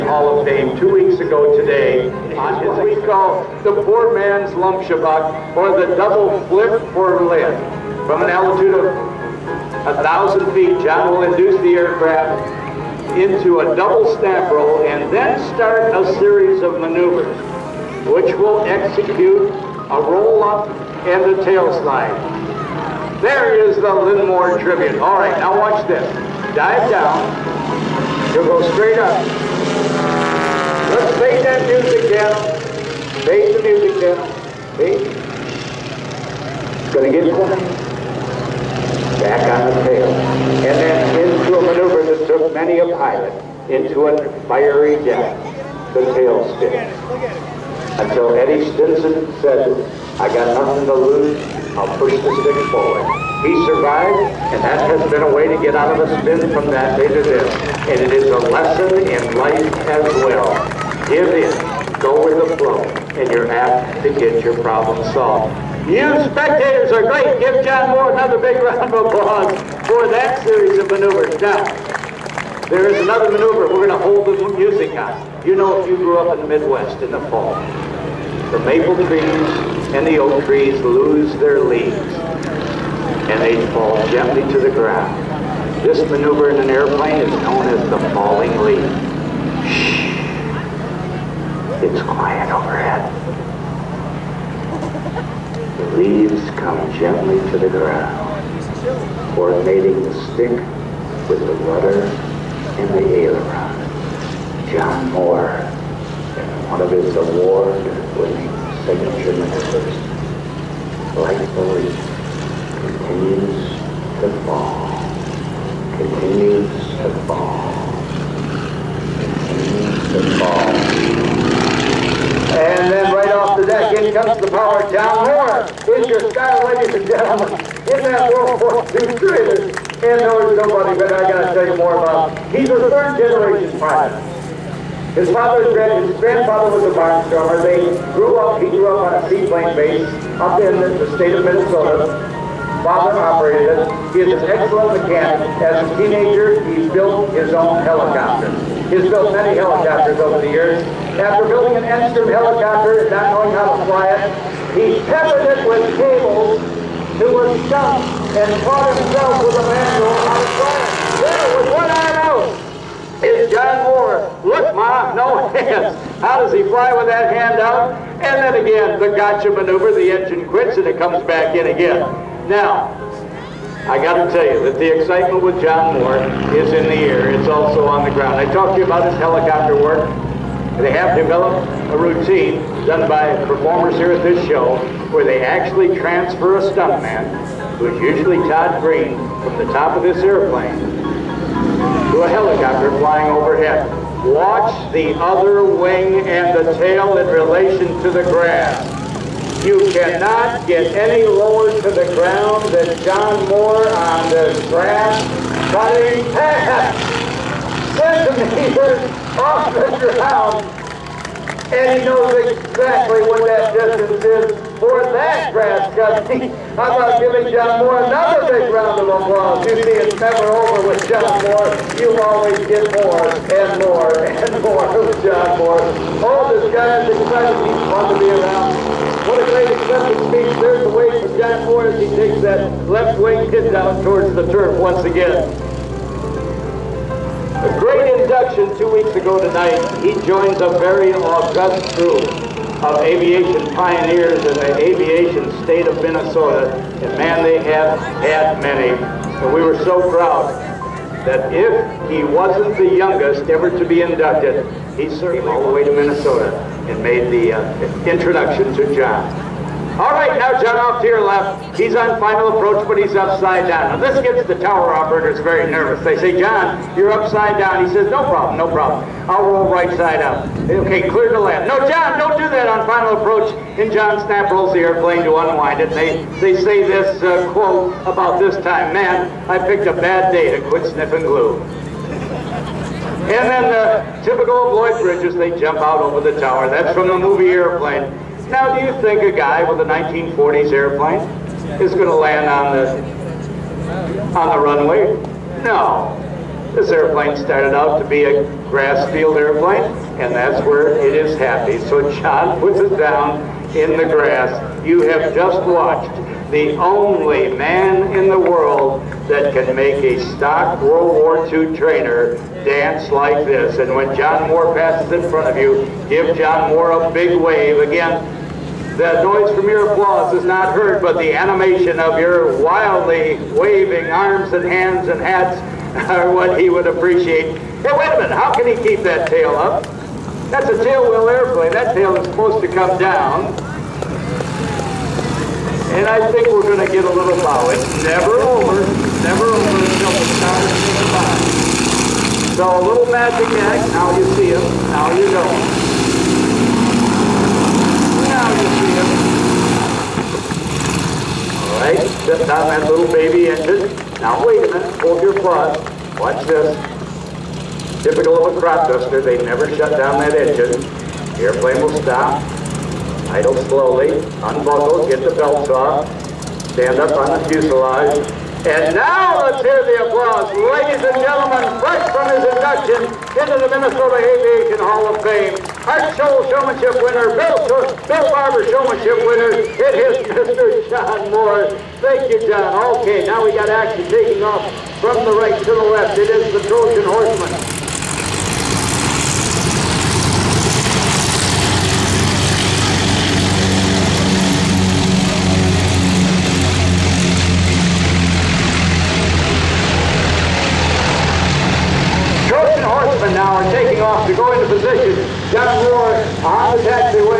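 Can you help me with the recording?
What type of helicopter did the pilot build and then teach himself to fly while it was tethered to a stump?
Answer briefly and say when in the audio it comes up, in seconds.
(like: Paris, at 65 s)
Enstrom, at 151 s.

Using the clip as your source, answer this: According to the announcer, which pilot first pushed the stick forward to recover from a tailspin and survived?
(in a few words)
Eddie Stinson.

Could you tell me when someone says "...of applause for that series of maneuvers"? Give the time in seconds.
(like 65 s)
68 s.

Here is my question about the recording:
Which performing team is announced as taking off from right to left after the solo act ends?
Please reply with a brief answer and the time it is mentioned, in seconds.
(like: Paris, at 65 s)
Trojan Horsemen, at 386 s.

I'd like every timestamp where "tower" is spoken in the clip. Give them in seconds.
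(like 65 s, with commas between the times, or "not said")
264 s, 286 s.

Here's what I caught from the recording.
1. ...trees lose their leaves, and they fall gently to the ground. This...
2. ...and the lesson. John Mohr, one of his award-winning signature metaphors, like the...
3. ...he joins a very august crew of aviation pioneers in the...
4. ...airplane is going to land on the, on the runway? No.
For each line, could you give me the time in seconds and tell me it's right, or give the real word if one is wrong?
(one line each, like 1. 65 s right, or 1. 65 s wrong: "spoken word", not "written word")
1. 80 s right
2. 102 s wrong: "aileron", not "lesson"
3. 240 s right
4. 290 s right.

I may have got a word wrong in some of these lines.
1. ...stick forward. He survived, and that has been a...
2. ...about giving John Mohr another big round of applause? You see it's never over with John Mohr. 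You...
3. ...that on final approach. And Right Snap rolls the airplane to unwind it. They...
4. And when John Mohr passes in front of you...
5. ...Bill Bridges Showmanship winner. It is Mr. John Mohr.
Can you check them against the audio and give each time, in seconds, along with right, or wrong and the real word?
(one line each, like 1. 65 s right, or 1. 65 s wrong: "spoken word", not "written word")
1. 52 s right
2. 216 s right
3. 272 s wrong: "John", not "Right"
4. 313 s right
5. 378 s wrong: "Barber", not "Bridges".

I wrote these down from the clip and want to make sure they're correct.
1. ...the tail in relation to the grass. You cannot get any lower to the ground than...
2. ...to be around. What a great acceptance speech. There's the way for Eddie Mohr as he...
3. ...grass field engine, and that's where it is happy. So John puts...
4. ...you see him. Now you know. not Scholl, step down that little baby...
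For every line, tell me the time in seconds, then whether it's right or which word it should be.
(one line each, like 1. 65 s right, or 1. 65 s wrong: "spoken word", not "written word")
1. 196 s right
2. 228 s wrong: "John", not "Eddie"
3. 298 s wrong: "airplane", not "engine"
4. 344 s wrong: "Right", not "Scholl".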